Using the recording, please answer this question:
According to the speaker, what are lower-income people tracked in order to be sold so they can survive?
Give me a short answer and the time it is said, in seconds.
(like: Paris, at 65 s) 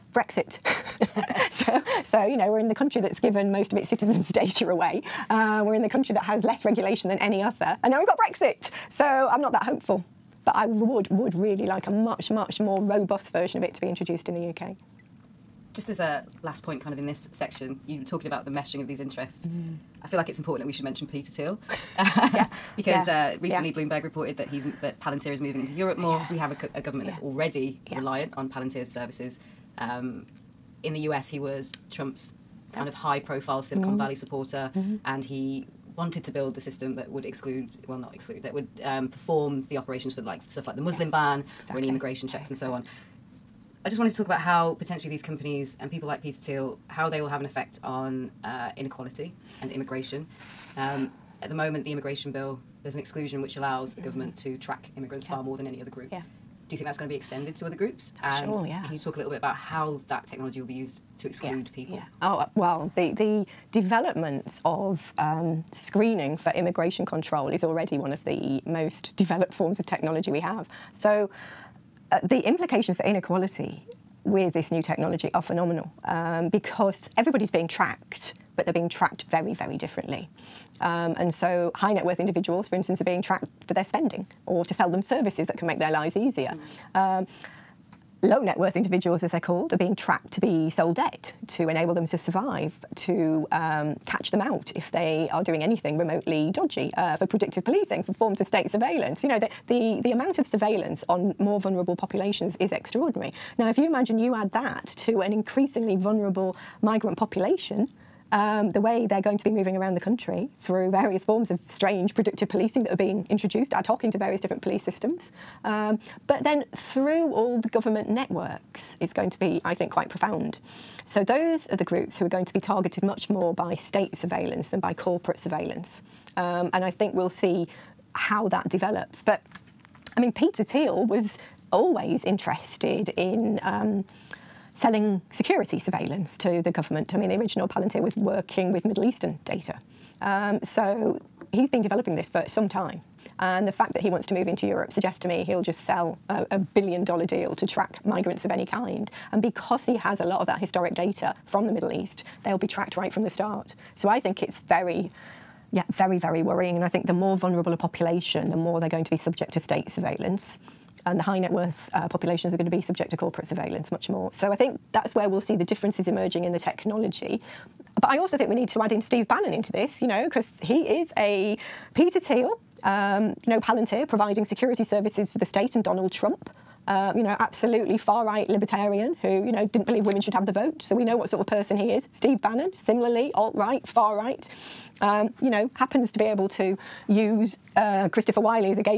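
Debt, at 90 s.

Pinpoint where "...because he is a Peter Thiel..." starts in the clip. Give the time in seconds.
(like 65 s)
170 s.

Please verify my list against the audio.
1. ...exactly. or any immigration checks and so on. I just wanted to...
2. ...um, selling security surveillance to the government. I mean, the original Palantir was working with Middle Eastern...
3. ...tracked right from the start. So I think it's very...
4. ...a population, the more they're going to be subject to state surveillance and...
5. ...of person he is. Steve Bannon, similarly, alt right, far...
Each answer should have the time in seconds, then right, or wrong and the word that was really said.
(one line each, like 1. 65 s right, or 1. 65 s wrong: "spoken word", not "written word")
1. 41 s right
2. 133 s right
3. 152 s right
4. 157 s right
5. 181 s right.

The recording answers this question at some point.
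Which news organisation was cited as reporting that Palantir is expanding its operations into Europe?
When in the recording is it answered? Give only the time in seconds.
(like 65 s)
23 s.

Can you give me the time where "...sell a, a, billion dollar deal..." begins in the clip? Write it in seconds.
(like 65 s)
145 s.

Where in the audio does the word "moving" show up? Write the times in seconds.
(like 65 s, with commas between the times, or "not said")
25 s, 109 s.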